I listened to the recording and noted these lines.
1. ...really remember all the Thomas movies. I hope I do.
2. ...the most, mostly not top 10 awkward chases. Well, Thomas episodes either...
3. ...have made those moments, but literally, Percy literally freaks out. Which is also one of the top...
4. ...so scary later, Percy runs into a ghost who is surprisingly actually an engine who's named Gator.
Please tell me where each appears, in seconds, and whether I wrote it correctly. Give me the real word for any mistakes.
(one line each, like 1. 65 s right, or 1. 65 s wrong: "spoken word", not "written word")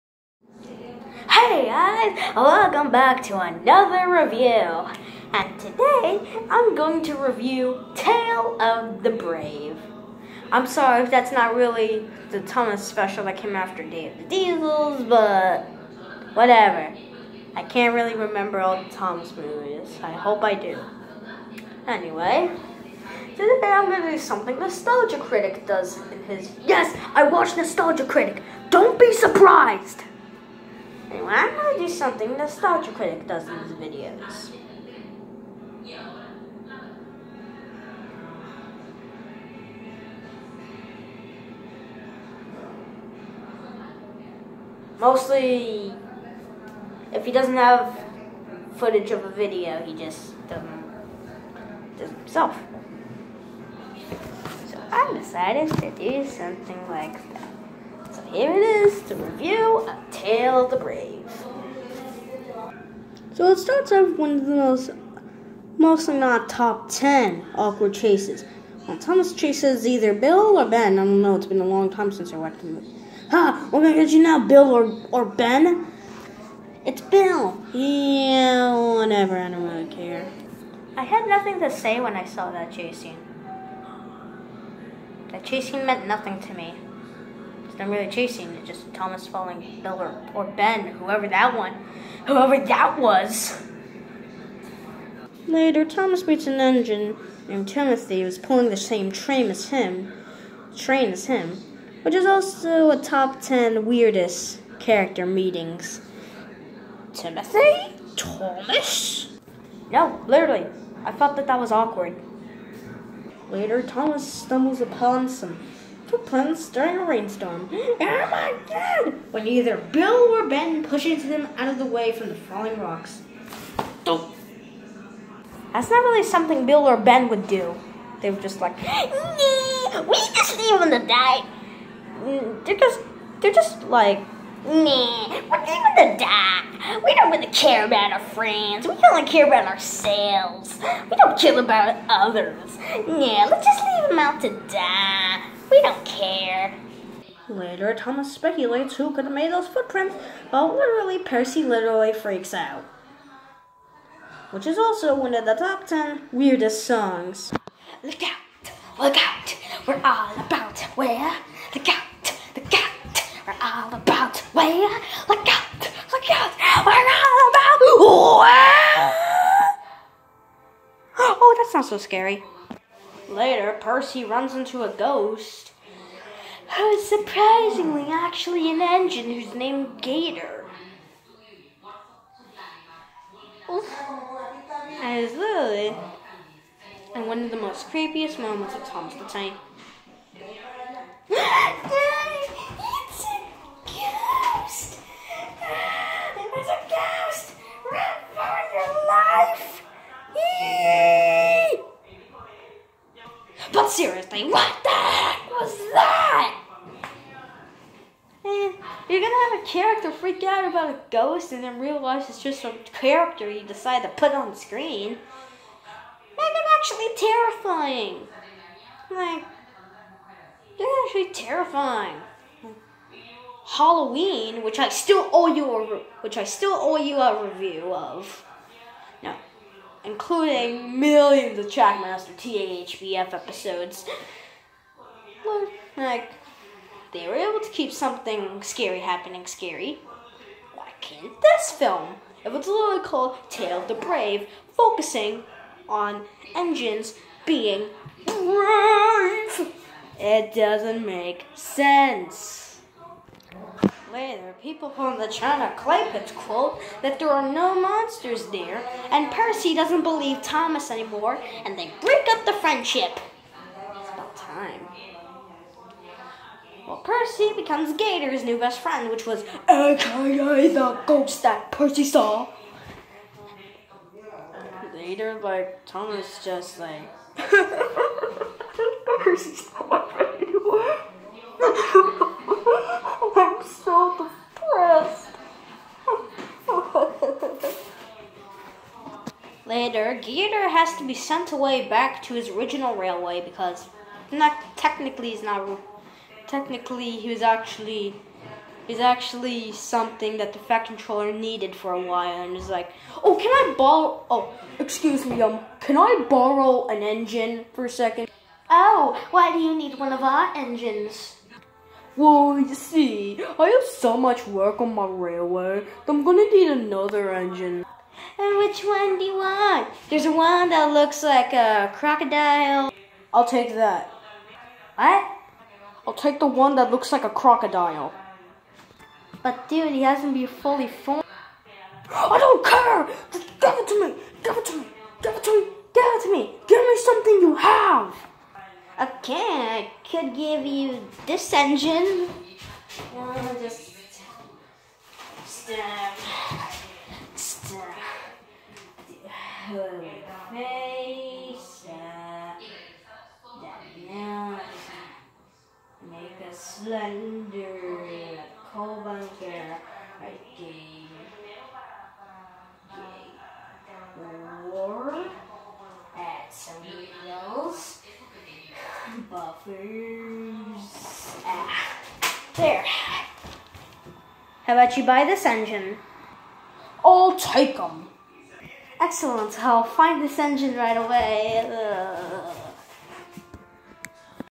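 1. 17 s right
2. 64 s wrong: "chases", not "episodes"
3. 149 s wrong: "footprints", not "moments"
4. 171 s right.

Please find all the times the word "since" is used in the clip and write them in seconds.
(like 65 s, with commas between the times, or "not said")
72 s.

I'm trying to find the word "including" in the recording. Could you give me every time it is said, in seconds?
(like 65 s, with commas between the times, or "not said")
230 s.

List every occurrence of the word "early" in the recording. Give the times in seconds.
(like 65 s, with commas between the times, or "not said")
not said.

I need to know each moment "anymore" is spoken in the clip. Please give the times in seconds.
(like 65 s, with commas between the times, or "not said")
260 s, 280 s.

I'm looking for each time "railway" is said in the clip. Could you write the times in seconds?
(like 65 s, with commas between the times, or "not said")
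292 s, 315 s.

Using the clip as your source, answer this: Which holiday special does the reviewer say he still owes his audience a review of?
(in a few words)
Halloween.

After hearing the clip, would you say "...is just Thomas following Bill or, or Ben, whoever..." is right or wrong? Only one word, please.
right.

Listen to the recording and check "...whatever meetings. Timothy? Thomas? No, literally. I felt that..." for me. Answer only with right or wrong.
wrong.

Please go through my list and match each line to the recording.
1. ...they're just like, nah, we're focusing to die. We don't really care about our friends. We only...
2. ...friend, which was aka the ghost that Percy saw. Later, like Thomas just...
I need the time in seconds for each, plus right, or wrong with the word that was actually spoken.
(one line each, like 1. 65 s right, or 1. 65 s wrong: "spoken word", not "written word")
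1. 133 s wrong: "leaving", not "focusing"
2. 268 s right.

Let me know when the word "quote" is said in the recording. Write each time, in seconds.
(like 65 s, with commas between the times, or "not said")
256 s.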